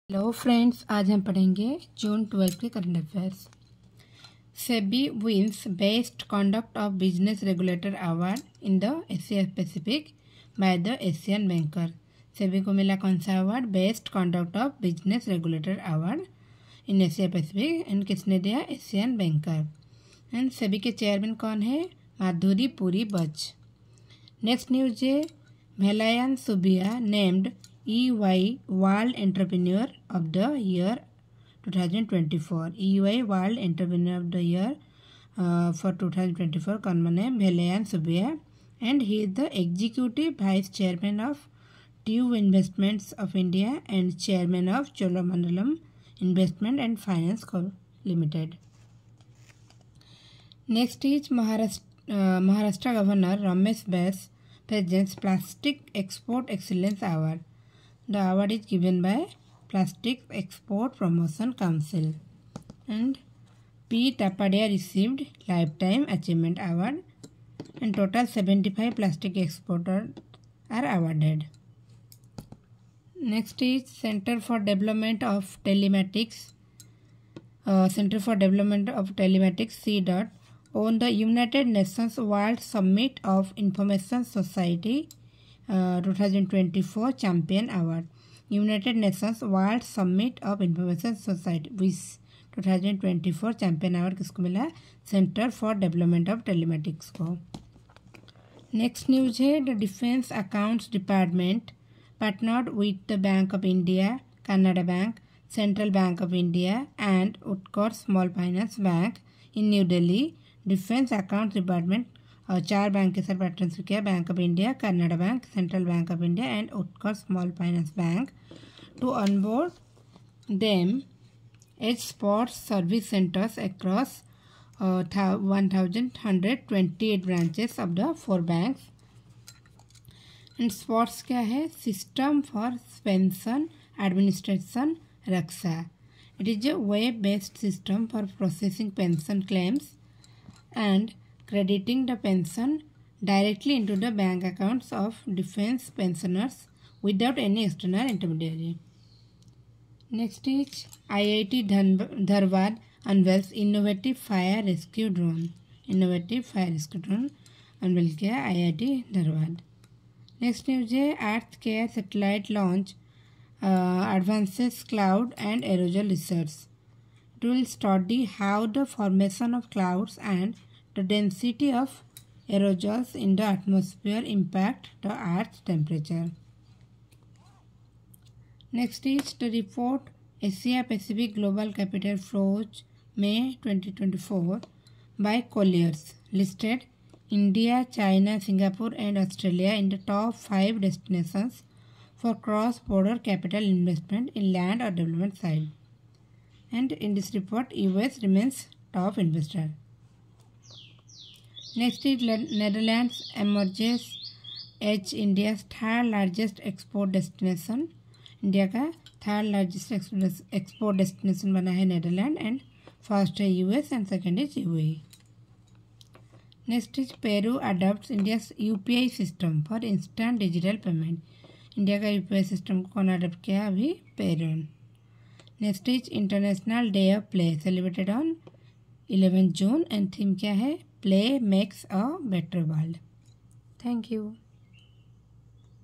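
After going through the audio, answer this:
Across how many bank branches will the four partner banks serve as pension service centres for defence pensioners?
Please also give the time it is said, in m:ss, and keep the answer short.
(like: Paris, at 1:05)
1128, at 2:04.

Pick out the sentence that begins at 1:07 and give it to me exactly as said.
And total 75 plastic exporters are awarded.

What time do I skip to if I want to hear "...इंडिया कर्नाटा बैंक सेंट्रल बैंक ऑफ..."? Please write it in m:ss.
1:54.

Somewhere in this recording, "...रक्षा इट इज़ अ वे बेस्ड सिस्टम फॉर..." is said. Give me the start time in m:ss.
2:15.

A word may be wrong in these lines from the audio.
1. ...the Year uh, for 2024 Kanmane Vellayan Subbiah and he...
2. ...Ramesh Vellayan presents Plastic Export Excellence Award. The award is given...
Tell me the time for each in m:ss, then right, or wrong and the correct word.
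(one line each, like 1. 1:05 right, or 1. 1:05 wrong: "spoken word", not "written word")
1. 0:34 right
2. 0:53 wrong: "Bais", not "Vellayan".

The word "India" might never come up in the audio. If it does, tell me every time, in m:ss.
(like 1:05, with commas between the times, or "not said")
0:43, 3:07.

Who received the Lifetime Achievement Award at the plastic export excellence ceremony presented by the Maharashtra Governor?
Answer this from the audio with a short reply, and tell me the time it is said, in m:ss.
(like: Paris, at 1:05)
P. Tapadia, at 1:03.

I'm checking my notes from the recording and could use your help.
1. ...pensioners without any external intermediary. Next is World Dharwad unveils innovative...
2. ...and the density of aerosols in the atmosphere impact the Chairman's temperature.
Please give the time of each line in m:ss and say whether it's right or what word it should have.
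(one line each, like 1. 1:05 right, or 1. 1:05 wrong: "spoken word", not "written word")
1. 2:25 wrong: "IIT", not "World"
2. 2:50 wrong: "Earth", not "Chairman".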